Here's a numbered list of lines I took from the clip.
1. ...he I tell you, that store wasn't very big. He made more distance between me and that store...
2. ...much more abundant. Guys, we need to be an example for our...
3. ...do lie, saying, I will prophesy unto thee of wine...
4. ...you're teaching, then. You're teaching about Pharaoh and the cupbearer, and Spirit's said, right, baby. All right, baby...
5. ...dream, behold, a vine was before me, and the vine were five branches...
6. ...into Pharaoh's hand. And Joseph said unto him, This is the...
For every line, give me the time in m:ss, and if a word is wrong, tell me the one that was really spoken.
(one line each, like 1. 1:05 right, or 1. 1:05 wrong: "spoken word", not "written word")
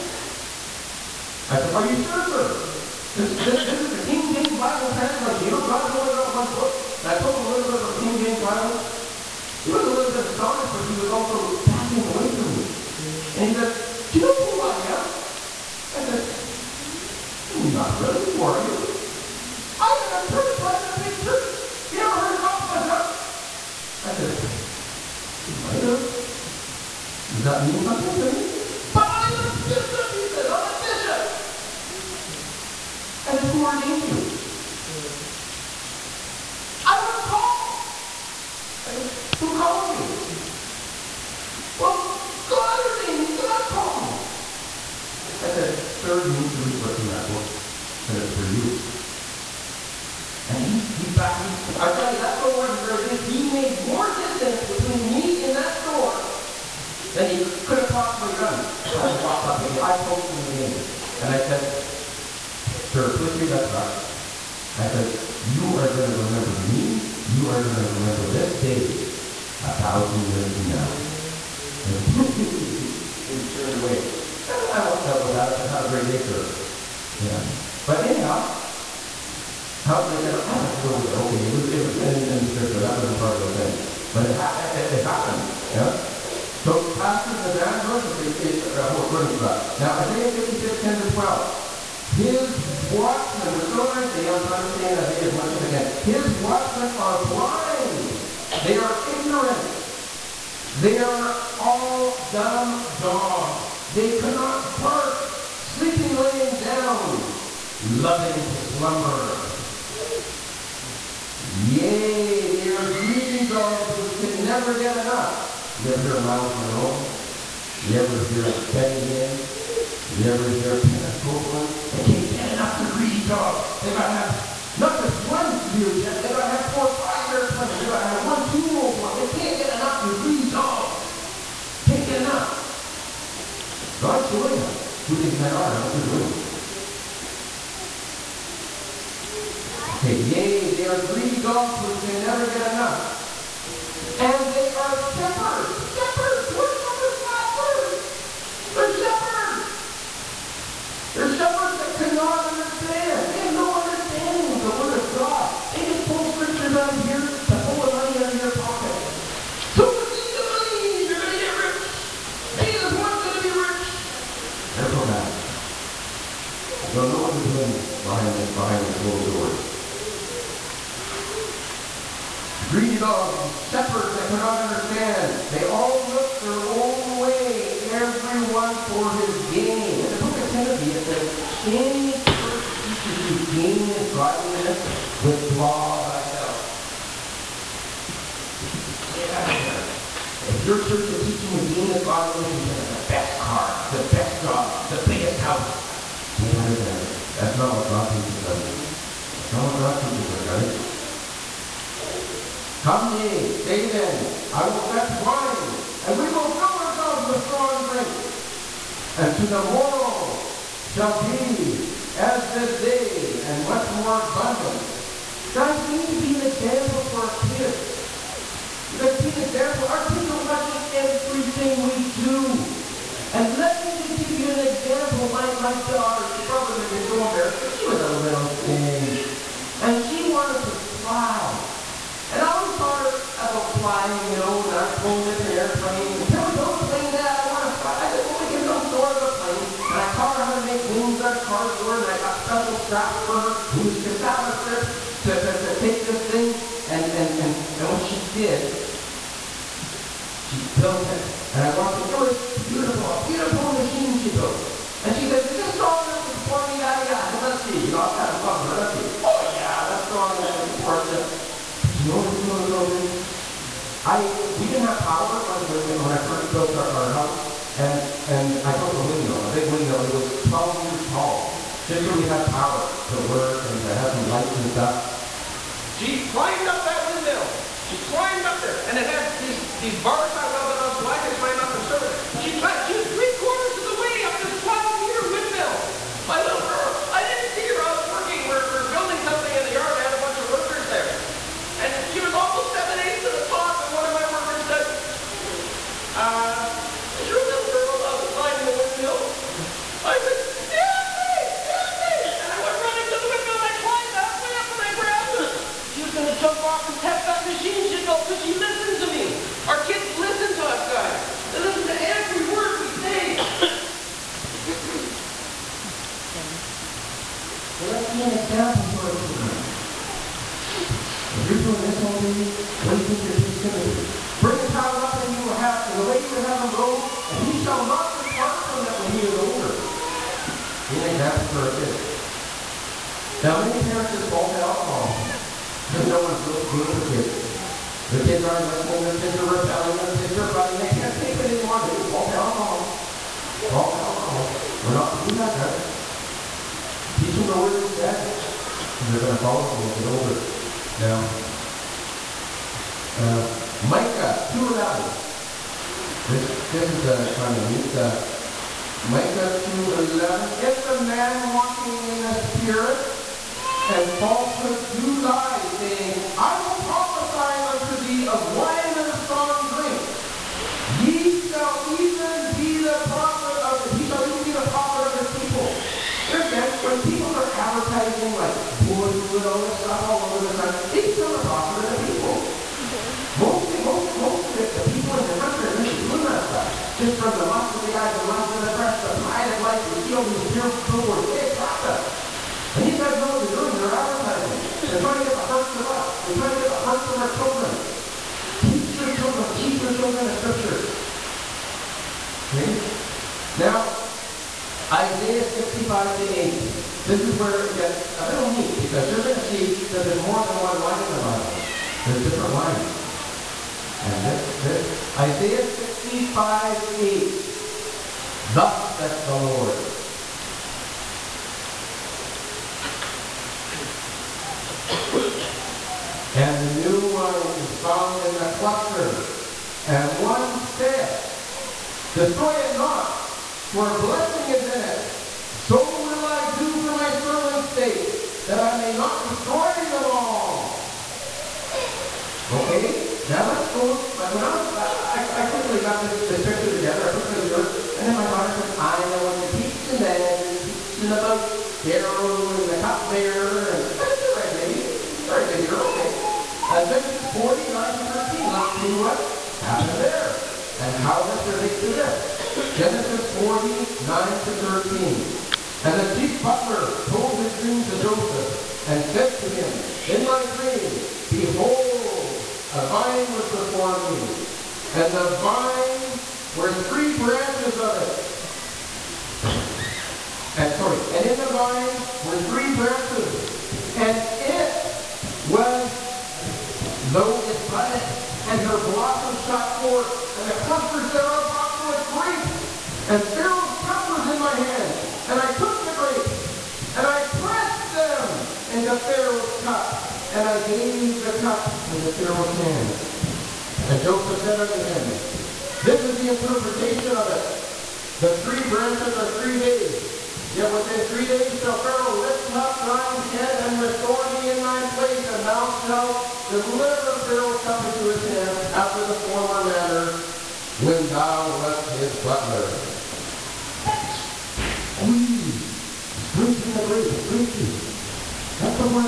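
1. 0:51 right
2. 3:33 right
3. 6:04 right
4. 7:29 wrong: "That", not "Spirit"
5. 7:50 wrong: "three", not "five"
6. 8:21 right.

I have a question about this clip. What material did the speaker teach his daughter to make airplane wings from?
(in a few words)
cardboard.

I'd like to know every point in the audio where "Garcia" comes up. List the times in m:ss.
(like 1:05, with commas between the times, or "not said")
not said.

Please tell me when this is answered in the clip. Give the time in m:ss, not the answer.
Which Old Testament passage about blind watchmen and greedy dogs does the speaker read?
1:30.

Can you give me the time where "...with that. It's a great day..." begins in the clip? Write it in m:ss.
1:15.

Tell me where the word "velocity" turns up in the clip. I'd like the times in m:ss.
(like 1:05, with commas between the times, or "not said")
not said.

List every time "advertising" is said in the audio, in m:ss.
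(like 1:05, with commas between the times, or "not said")
6:17, 6:33.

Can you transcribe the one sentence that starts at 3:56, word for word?
And can we build a plane that I want to fly?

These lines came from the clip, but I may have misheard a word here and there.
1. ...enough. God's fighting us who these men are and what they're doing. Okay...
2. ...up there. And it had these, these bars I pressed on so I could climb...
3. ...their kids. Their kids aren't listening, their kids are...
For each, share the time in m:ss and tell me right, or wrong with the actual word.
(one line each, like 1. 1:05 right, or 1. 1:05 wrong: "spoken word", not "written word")
1. 2:12 wrong: "showing", not "fighting"
2. 4:38 wrong: "welded", not "pressed"
3. 5:36 right.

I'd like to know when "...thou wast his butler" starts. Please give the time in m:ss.
8:41.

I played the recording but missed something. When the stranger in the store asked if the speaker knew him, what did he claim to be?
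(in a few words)
a big church.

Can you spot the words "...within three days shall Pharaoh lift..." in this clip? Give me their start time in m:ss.
8:30.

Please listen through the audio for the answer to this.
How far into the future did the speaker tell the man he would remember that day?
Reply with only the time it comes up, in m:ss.
1:09.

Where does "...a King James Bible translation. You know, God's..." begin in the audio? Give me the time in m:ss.
0:03.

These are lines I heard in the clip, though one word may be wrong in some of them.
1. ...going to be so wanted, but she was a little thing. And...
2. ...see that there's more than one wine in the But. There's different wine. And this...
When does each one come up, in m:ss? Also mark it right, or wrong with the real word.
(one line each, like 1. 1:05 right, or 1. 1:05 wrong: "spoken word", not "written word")
1. 3:46 wrong: "embarrassed", not "wanted"
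2. 6:49 wrong: "Bible", not "But".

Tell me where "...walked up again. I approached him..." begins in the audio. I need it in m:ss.
0:59.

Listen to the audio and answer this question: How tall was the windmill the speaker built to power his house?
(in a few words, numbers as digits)
12 meters.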